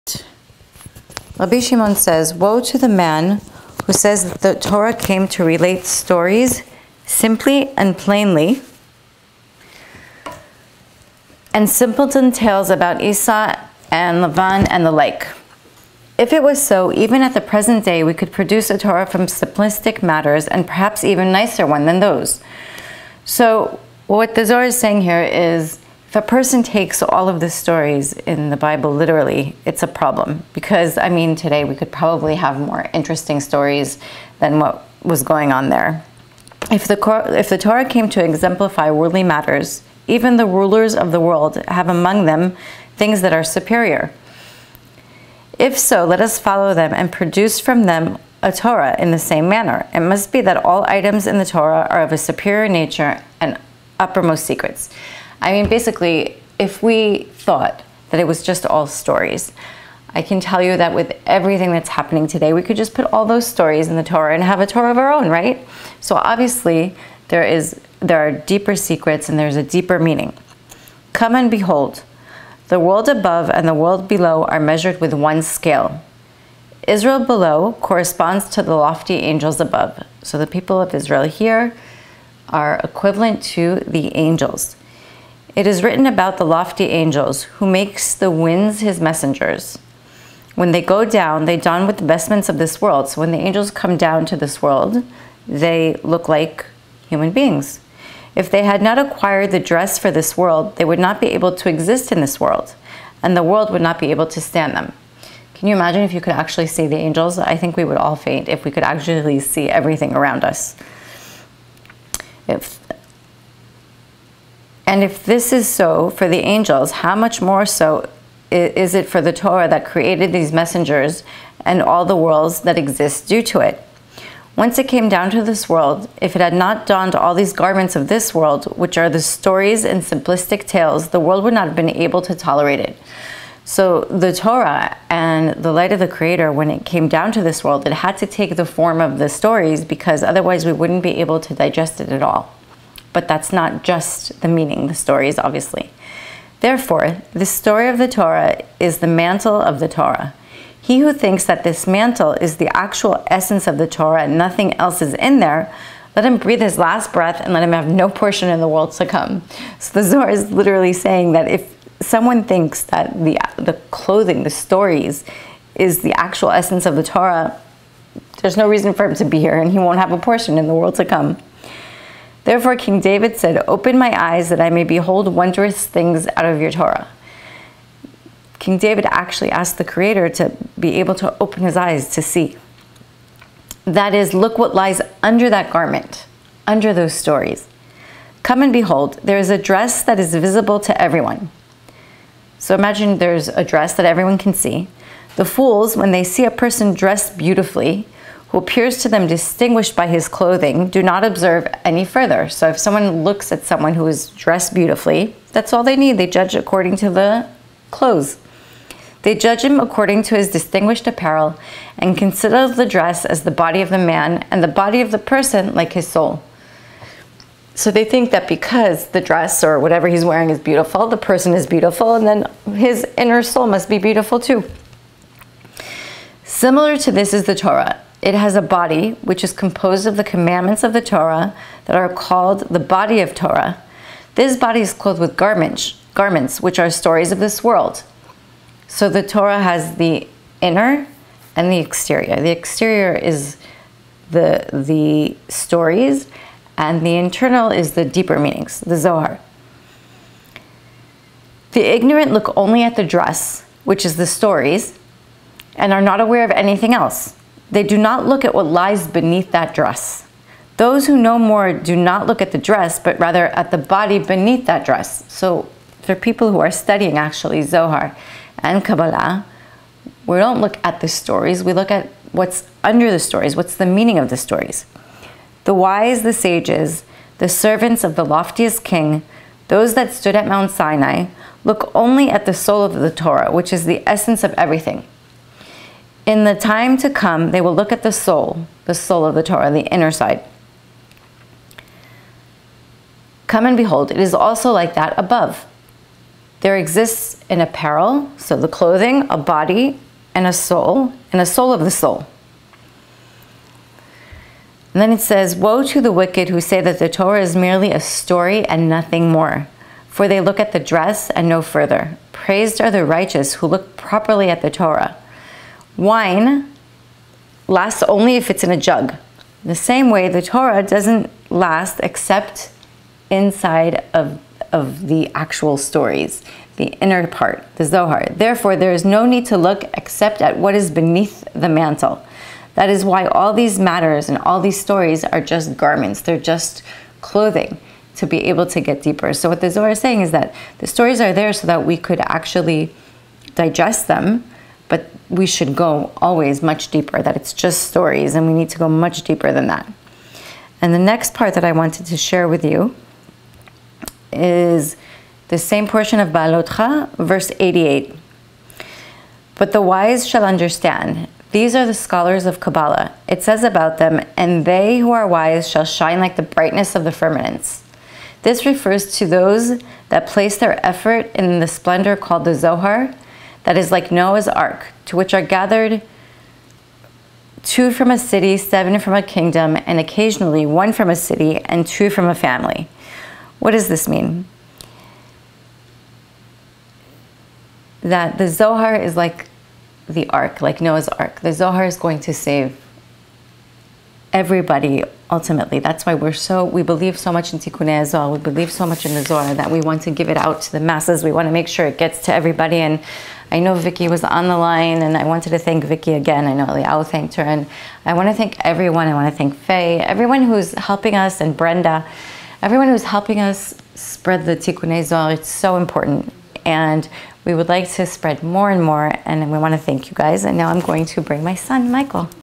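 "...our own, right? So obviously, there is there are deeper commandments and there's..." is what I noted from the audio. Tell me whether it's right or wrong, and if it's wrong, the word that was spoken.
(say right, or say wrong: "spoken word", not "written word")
wrong: "secrets", not "commandments".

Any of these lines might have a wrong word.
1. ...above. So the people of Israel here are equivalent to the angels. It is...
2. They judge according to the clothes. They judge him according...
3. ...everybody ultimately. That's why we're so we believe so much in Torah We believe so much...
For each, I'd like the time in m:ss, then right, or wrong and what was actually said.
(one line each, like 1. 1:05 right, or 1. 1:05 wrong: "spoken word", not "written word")
1. 1:19 right
2. 3:26 right
3. 6:34 wrong: "Tikkun", not "Torah".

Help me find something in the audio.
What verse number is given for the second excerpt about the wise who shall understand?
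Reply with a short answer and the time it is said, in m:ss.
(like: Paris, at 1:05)
88, at 5:57.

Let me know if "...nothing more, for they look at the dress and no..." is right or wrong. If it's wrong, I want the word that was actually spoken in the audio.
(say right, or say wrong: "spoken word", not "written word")
right.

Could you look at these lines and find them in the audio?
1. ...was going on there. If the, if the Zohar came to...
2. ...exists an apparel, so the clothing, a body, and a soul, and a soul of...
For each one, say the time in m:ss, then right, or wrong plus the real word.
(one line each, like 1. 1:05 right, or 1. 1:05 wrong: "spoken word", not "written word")
1. 0:35 wrong: "Torah", not "Zohar"
2. 4:56 right.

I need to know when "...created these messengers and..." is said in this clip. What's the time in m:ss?
1:59.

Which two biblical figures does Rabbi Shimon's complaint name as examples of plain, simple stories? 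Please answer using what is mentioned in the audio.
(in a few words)
Esau and Lavan.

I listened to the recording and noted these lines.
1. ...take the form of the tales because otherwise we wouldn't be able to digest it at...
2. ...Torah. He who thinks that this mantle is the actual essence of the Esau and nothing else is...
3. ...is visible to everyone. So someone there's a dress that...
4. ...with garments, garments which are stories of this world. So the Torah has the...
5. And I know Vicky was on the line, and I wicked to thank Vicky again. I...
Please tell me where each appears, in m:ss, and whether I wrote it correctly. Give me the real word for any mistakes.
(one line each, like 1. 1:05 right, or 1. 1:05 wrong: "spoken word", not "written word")
1. 2:18 wrong: "stories", not "tales"
2. 2:29 wrong: "Torah", not "Esau"
3. 3:10 wrong: "imagine", not "someone"
4. 3:55 right
5. 6:42 wrong: "wanted", not "wicked".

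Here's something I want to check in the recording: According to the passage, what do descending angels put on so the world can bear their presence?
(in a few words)
vestments of this world.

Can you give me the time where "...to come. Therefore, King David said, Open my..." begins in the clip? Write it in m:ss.
2:50.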